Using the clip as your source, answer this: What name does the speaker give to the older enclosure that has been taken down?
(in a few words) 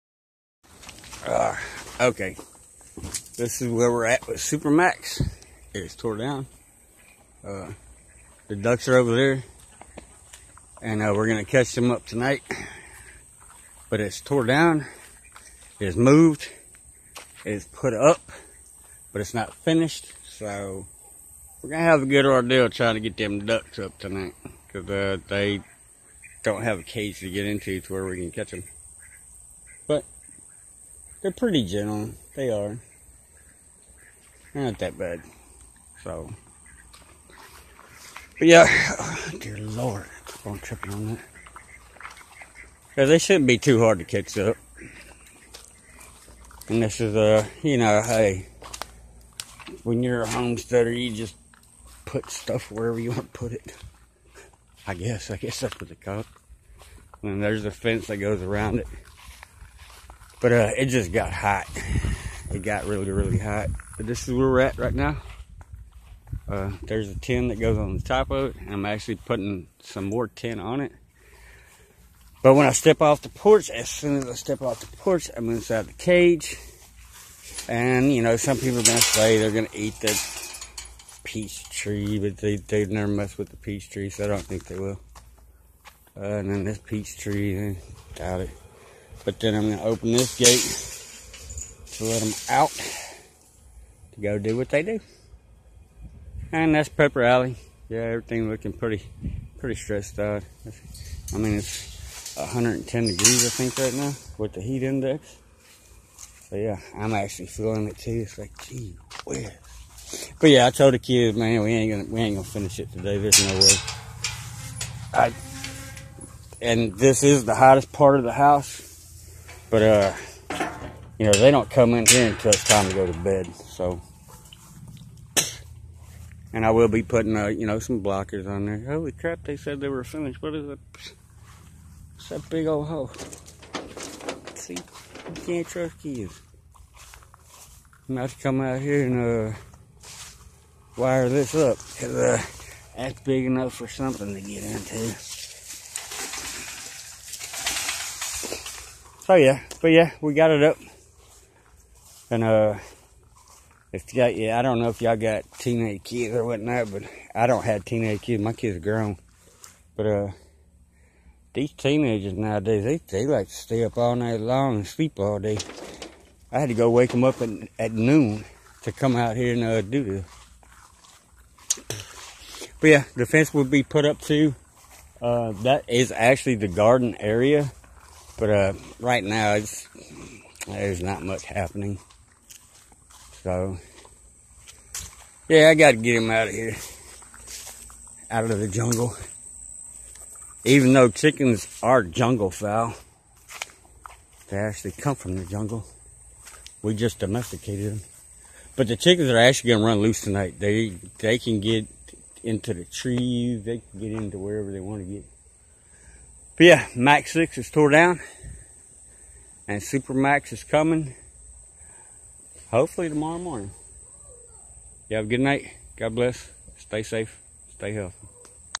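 Max 6.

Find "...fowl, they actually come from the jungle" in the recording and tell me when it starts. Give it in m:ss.
3:12.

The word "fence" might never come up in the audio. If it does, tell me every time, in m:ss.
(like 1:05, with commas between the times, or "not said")
0:57, 2:53.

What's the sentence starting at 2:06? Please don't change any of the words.
And I will be putting, uh, you know, some blockers on there.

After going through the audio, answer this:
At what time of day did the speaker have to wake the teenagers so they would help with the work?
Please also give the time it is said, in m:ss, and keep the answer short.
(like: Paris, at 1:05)
Noon, at 2:47.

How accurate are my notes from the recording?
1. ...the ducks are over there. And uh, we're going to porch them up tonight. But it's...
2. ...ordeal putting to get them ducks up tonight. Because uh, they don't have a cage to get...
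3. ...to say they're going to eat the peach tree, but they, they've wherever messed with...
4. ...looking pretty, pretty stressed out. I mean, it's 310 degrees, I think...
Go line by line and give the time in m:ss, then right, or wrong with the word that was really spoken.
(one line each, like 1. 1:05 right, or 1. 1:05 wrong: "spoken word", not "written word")
1. 0:08 wrong: "catch", not "porch"
2. 0:22 wrong: "trying", not "putting"
3. 1:18 wrong: "never", not "wherever"
4. 1:38 wrong: "110", not "310".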